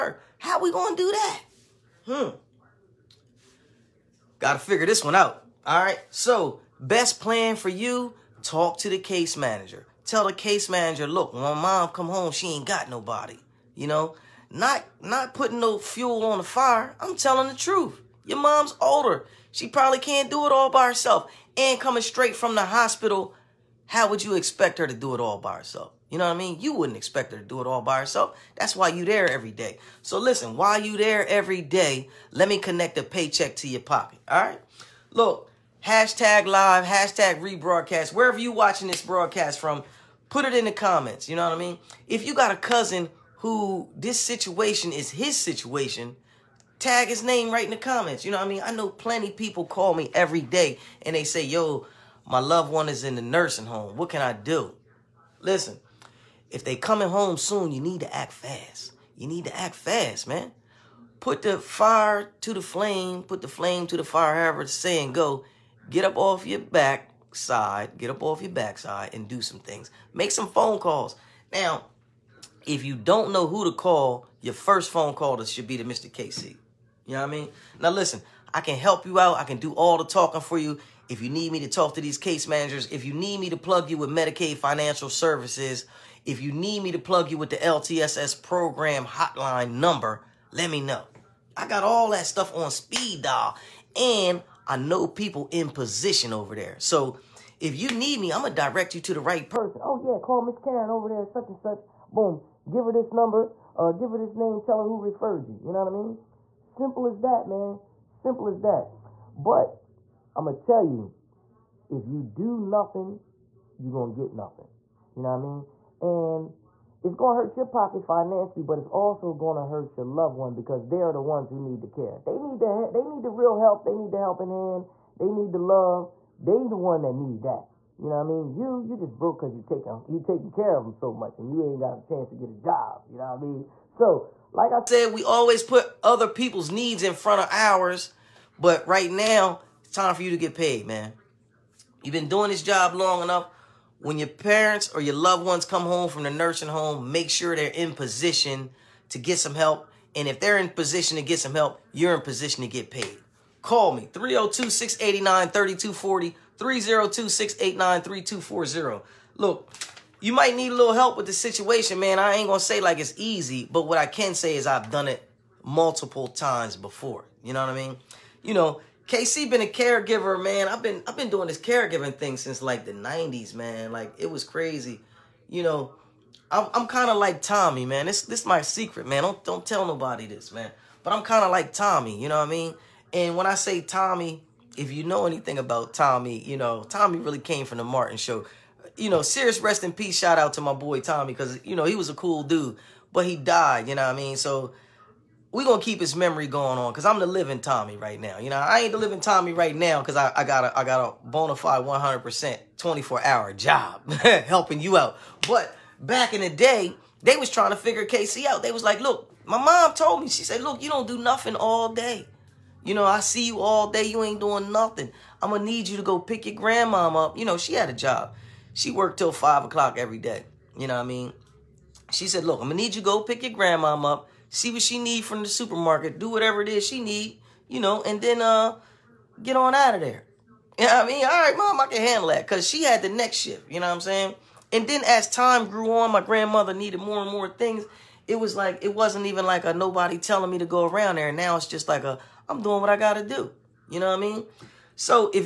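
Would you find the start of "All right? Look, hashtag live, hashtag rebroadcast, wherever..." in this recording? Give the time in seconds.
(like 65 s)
34 s.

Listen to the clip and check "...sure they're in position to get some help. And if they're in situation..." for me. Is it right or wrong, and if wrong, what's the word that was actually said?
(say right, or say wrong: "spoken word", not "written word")
wrong: "position", not "situation".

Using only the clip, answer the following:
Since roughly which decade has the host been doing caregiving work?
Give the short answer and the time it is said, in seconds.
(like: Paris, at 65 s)
the '90s, at 172 s.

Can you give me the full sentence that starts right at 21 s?
And coming straight from the hospital, how would you expect her to do it all by herself?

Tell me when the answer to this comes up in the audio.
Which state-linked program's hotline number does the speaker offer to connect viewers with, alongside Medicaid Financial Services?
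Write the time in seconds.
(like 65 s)
87 s.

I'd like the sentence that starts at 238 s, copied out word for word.
It was like it wasn't even like a nobody telling me to go around there.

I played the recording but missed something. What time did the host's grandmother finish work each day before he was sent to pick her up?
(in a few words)
5 o'clock.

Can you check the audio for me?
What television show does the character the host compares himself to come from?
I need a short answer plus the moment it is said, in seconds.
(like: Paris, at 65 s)
Martin Show, at 187 s.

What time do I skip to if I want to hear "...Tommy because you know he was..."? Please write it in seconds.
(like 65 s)
190 s.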